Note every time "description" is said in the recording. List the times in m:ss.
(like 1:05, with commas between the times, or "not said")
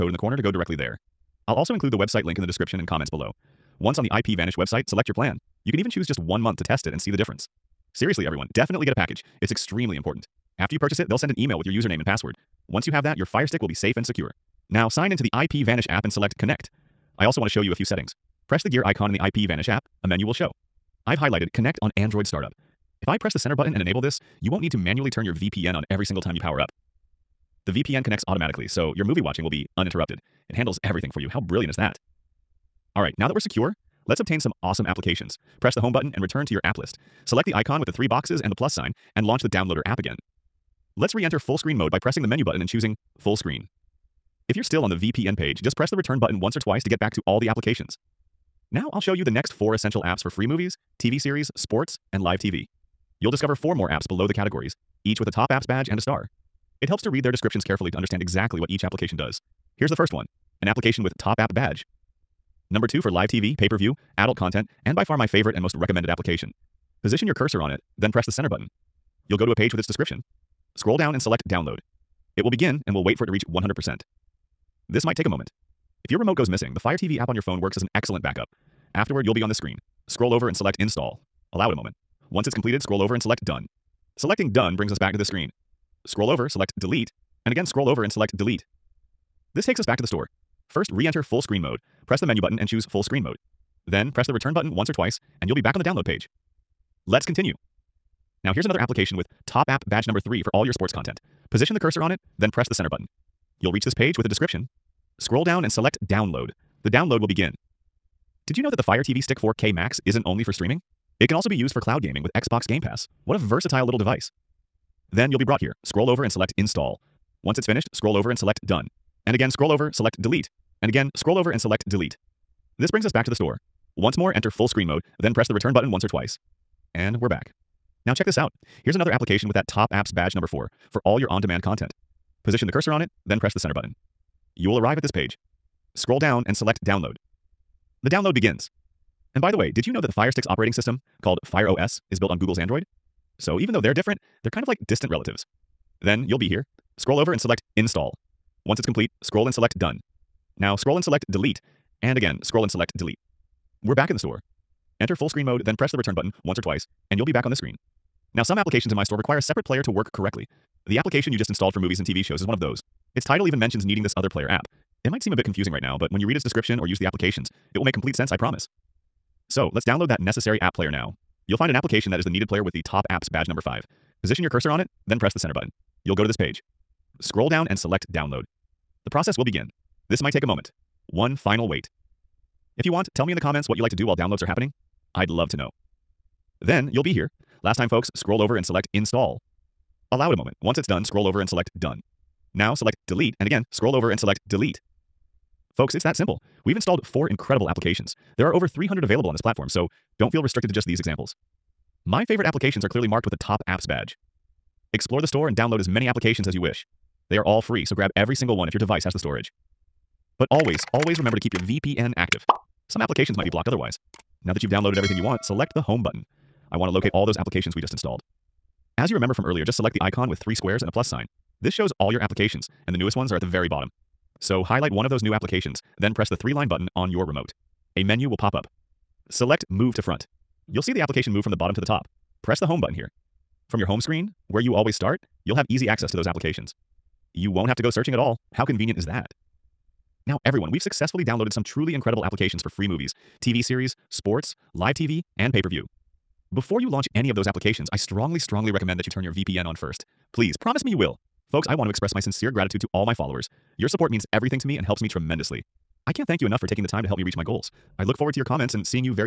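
0:02, 0:57, 1:09, 1:44, 2:46.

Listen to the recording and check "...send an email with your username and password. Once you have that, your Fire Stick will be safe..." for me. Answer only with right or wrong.
right.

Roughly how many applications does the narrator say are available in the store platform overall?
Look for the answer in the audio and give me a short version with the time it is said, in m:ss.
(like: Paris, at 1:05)
over 300, at 3:18.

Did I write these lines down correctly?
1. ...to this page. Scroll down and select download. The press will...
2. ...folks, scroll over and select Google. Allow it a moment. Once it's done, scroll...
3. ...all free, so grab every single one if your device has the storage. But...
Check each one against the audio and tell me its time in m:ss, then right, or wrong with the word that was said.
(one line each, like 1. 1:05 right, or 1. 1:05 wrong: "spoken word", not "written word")
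1. 2:56 wrong: "process", not "press"
2. 3:07 wrong: "Install", not "Google"
3. 3:27 right.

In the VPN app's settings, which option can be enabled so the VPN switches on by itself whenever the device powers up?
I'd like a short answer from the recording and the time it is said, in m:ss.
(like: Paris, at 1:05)
Connect on Android Startup, at 0:21.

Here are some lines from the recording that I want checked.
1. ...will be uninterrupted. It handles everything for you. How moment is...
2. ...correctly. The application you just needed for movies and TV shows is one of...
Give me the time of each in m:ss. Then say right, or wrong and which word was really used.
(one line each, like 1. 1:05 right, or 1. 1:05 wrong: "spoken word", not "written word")
1. 0:29 wrong: "brilliant", not "moment"
2. 2:40 wrong: "installed", not "needed".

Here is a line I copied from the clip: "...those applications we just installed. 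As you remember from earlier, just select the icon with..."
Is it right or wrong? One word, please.
right.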